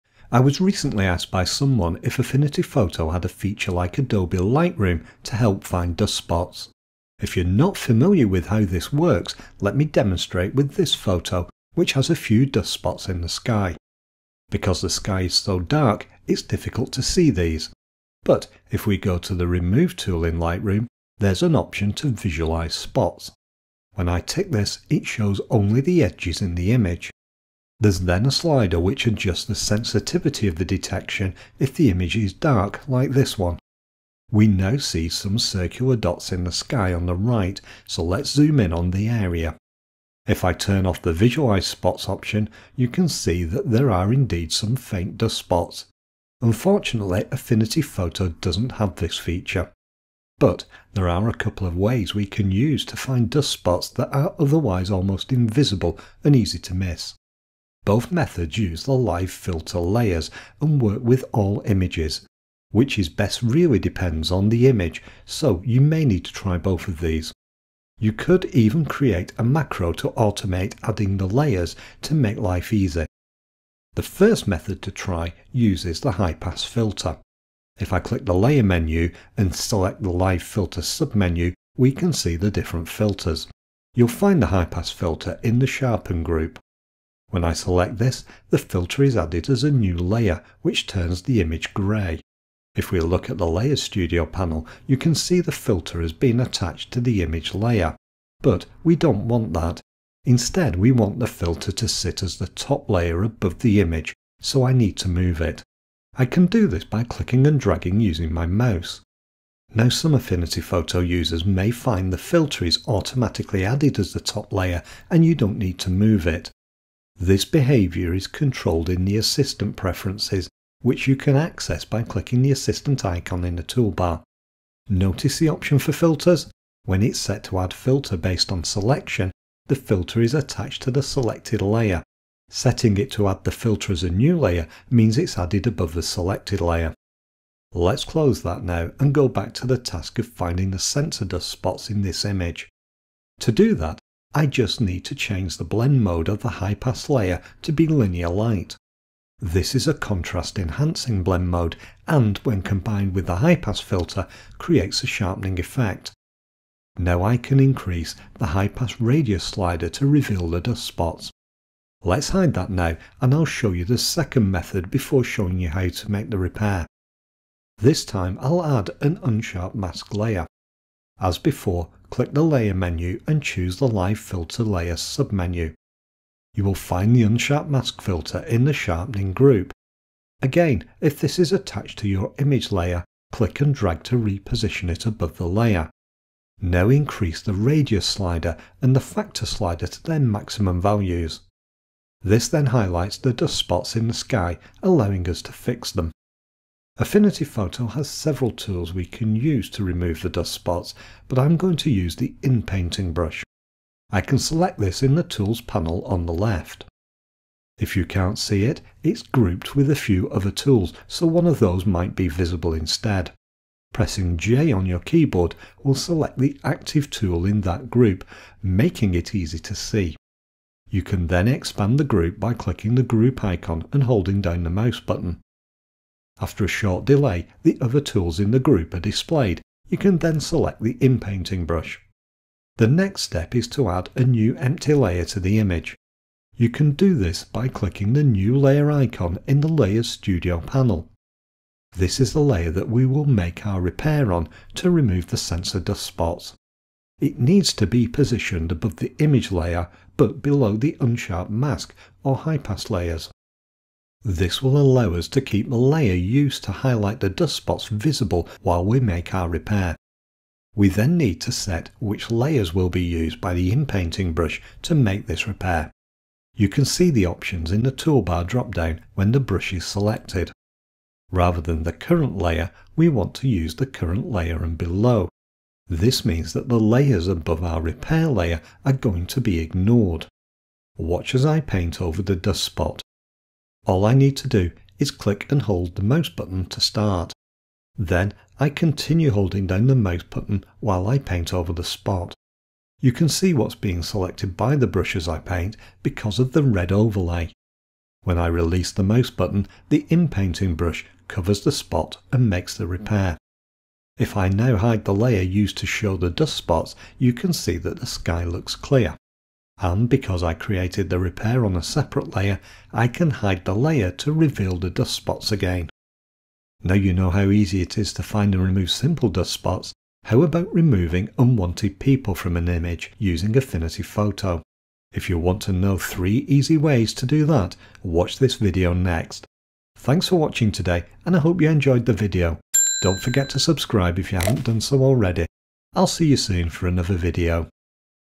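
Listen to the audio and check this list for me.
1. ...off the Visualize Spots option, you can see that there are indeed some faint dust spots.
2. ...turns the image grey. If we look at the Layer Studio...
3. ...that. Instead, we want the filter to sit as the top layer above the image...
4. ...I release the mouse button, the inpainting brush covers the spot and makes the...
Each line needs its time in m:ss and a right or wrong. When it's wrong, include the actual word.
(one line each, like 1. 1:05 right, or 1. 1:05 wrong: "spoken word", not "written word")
1. 0:40 right
2. 1:30 right
3. 1:39 right
4. 4:58 right.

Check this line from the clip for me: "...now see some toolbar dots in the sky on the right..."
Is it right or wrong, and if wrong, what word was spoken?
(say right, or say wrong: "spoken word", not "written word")
wrong: "circular", not "toolbar".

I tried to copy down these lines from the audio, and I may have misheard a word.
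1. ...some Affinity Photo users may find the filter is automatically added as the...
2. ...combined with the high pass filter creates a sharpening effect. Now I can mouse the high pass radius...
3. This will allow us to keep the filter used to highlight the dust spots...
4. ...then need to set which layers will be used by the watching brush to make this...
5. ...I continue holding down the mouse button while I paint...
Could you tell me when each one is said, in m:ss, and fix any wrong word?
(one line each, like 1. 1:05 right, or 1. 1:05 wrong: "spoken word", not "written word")
1. 1:49 right
2. 2:32 wrong: "increase", not "mouse"
3. 4:14 wrong: "layer", not "filter"
4. 4:20 wrong: "inpainting", not "watching"
5. 4:48 right.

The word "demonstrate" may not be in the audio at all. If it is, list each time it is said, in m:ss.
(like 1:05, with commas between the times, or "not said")
0:09.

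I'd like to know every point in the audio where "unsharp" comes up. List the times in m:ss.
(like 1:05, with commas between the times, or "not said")
2:49, 2:57, 4:10.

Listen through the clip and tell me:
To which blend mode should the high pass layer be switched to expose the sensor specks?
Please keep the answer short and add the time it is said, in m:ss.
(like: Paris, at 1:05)
linear light, at 2:27.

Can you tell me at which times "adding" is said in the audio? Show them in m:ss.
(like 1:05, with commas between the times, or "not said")
1:10.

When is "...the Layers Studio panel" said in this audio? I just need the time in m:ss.
3:59.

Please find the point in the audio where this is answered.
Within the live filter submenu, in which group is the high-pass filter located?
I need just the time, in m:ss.
1:25.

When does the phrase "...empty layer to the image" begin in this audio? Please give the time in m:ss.
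3:54.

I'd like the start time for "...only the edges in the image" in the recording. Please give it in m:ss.
0:25.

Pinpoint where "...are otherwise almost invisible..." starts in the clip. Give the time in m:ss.
0:54.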